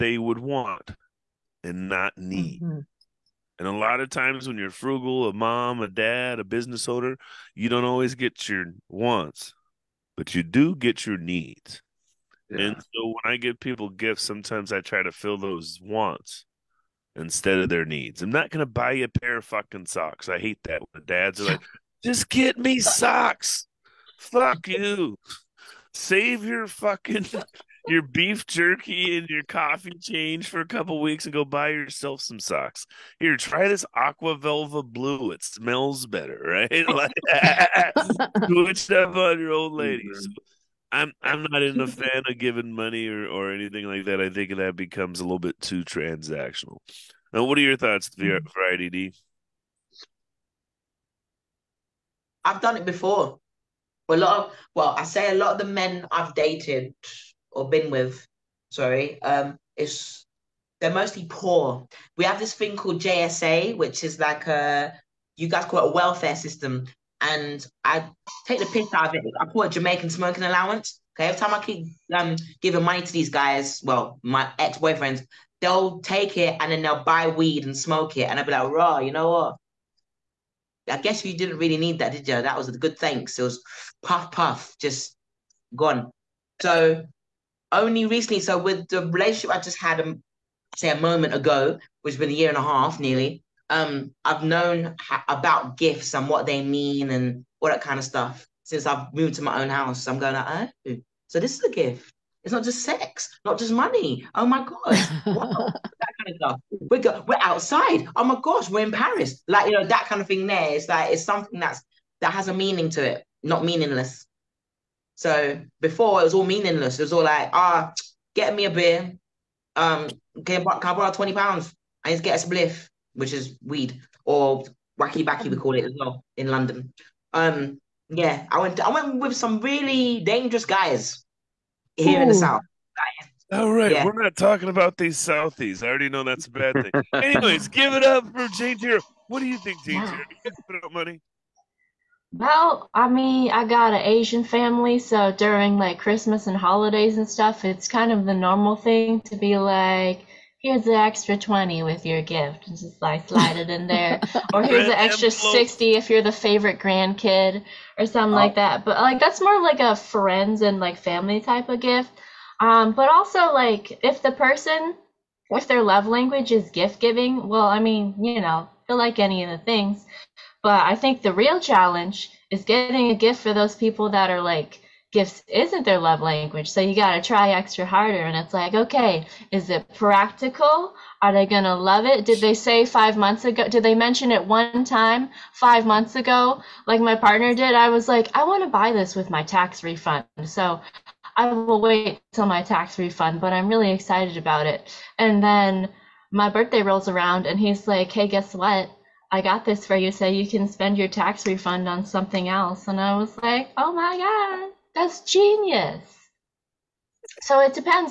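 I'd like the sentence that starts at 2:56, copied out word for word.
So you got to try extra harder.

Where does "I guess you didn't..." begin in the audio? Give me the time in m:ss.
1:20.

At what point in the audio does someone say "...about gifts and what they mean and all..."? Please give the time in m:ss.
1:35.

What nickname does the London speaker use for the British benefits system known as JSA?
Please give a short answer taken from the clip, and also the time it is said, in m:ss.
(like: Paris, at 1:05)
Jamaican smoking allowance, at 1:09.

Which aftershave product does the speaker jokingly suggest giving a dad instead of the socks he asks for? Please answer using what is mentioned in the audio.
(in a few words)
Aqua Velva.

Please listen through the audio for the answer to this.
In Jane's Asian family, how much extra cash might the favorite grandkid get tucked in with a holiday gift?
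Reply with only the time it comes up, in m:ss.
2:35.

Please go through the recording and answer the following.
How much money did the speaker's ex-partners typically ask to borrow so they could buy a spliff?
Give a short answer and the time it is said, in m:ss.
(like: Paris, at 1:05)
20 pounds, at 2:01.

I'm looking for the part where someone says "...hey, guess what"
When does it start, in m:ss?
3:18.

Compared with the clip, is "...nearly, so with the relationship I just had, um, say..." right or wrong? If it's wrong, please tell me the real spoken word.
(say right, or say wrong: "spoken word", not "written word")
wrong: "recently", not "nearly".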